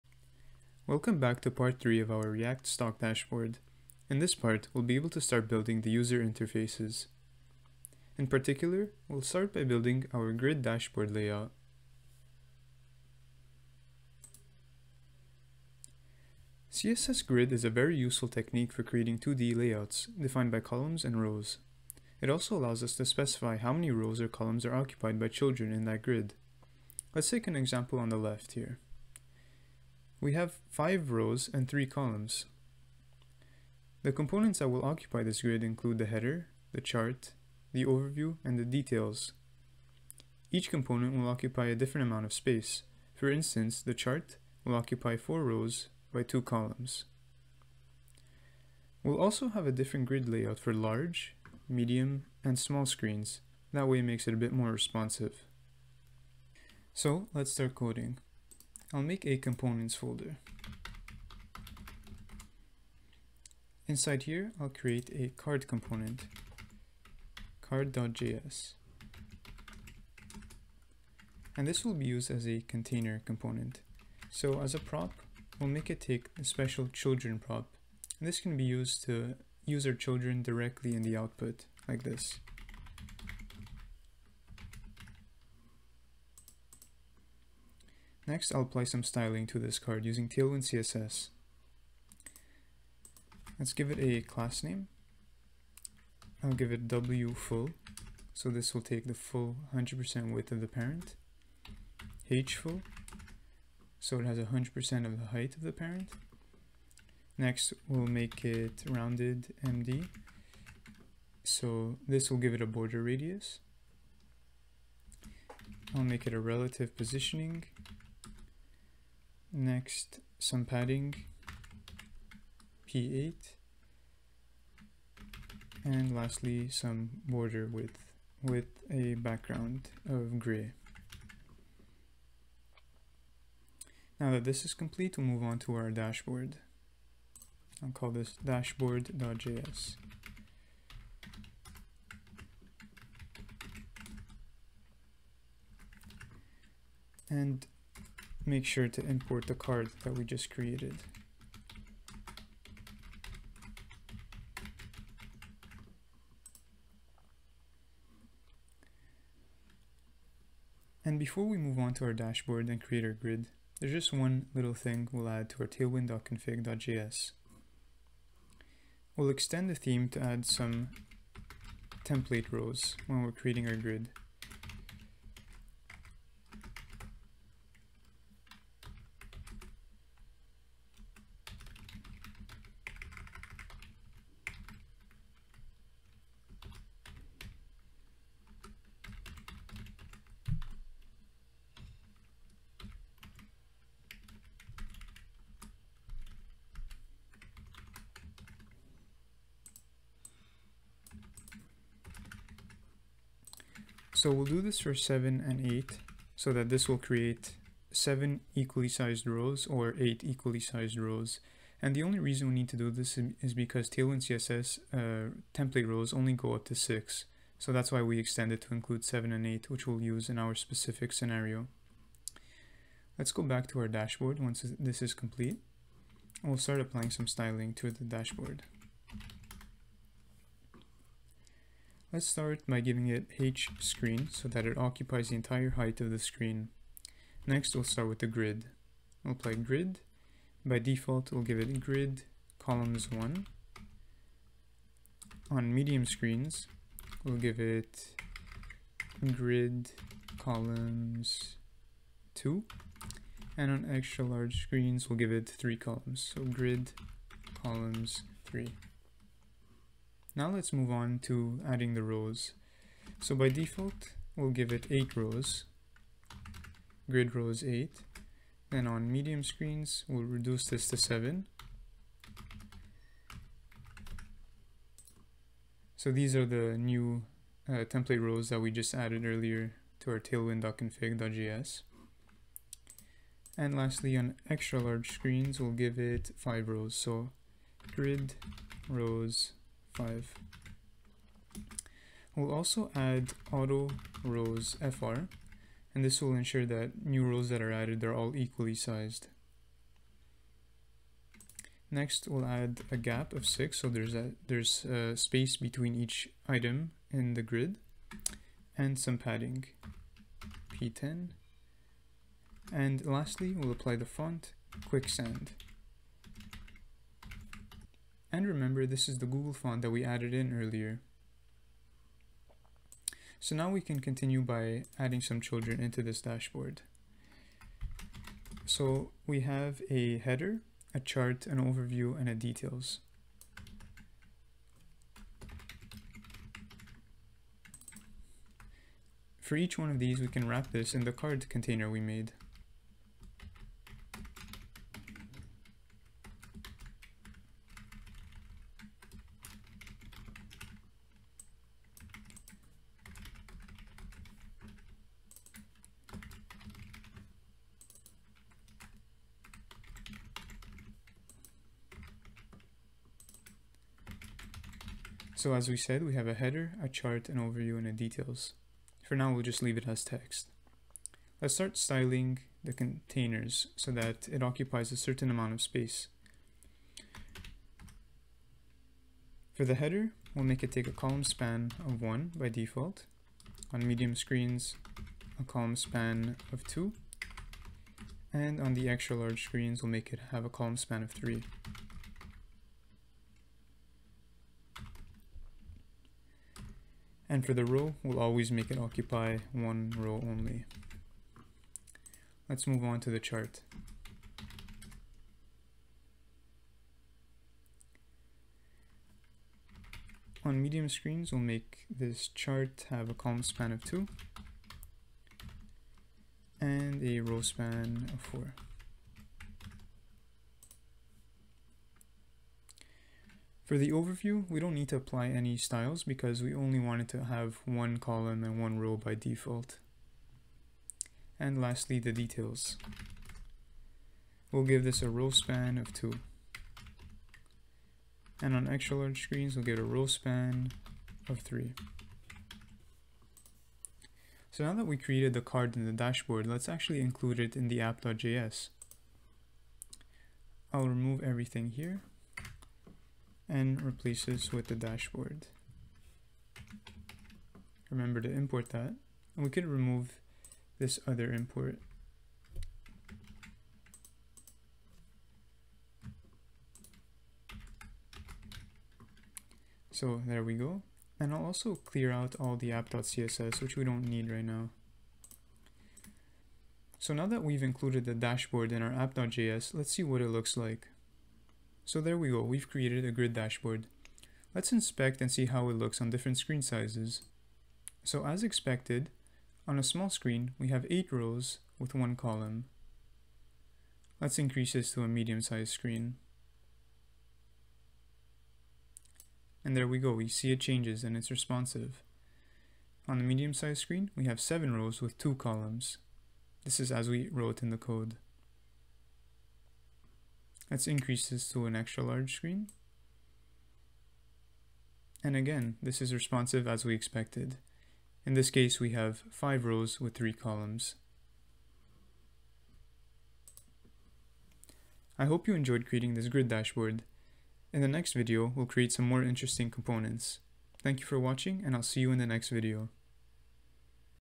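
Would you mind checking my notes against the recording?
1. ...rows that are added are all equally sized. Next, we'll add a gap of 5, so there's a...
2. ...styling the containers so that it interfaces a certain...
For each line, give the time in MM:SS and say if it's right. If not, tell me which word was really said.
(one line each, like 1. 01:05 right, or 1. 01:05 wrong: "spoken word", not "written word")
1. 04:57 wrong: "6", not "5"
2. 06:11 wrong: "occupies", not "interfaces".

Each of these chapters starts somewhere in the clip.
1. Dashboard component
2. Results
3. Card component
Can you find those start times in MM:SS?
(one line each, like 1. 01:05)
1. 02:12
2. 07:56
3. 00:56.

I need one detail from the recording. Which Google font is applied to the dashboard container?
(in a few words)
Quicksand.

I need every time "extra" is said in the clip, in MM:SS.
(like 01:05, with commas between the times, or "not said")
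04:13, 04:44, 06:28, 07:18, 08:31.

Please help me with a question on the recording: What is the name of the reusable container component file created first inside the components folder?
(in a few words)
card.js.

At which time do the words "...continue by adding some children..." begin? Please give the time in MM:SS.
05:23.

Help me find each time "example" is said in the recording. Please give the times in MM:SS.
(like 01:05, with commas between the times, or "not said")
00:27.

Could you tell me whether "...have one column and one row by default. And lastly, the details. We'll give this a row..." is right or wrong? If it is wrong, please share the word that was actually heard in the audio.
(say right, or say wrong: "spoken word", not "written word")
right.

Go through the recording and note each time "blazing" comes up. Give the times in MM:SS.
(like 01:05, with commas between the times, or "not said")
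not said.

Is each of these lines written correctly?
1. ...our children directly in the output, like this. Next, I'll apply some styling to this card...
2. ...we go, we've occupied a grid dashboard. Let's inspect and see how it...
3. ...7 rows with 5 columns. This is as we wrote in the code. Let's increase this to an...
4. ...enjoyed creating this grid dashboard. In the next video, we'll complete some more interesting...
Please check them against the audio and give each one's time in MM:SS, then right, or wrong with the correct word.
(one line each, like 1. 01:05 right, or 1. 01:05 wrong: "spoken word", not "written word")
1. 01:19 right
2. 08:02 wrong: "created", not "occupied"
3. 08:24 wrong: "2", not "5"
4. 08:45 wrong: "create", not "complete".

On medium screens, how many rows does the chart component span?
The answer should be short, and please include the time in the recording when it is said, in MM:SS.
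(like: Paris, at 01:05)
4, at 06:58.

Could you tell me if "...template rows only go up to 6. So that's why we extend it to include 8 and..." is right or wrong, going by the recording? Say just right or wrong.
wrong.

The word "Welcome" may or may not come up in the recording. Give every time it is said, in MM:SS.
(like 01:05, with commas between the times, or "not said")
00:00.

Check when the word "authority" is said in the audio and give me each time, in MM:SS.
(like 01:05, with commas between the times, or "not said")
not said.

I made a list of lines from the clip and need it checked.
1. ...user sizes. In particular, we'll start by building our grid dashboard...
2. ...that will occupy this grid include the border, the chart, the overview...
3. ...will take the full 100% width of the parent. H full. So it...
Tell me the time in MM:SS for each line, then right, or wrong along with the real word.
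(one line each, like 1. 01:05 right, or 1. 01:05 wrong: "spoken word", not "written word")
1. 00:05 wrong: "interfaces", not "sizes"
2. 00:34 wrong: "header", not "border"
3. 01:38 right.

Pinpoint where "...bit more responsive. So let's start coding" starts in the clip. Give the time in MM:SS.
00:54.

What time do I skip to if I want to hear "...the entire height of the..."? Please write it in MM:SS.
03:55.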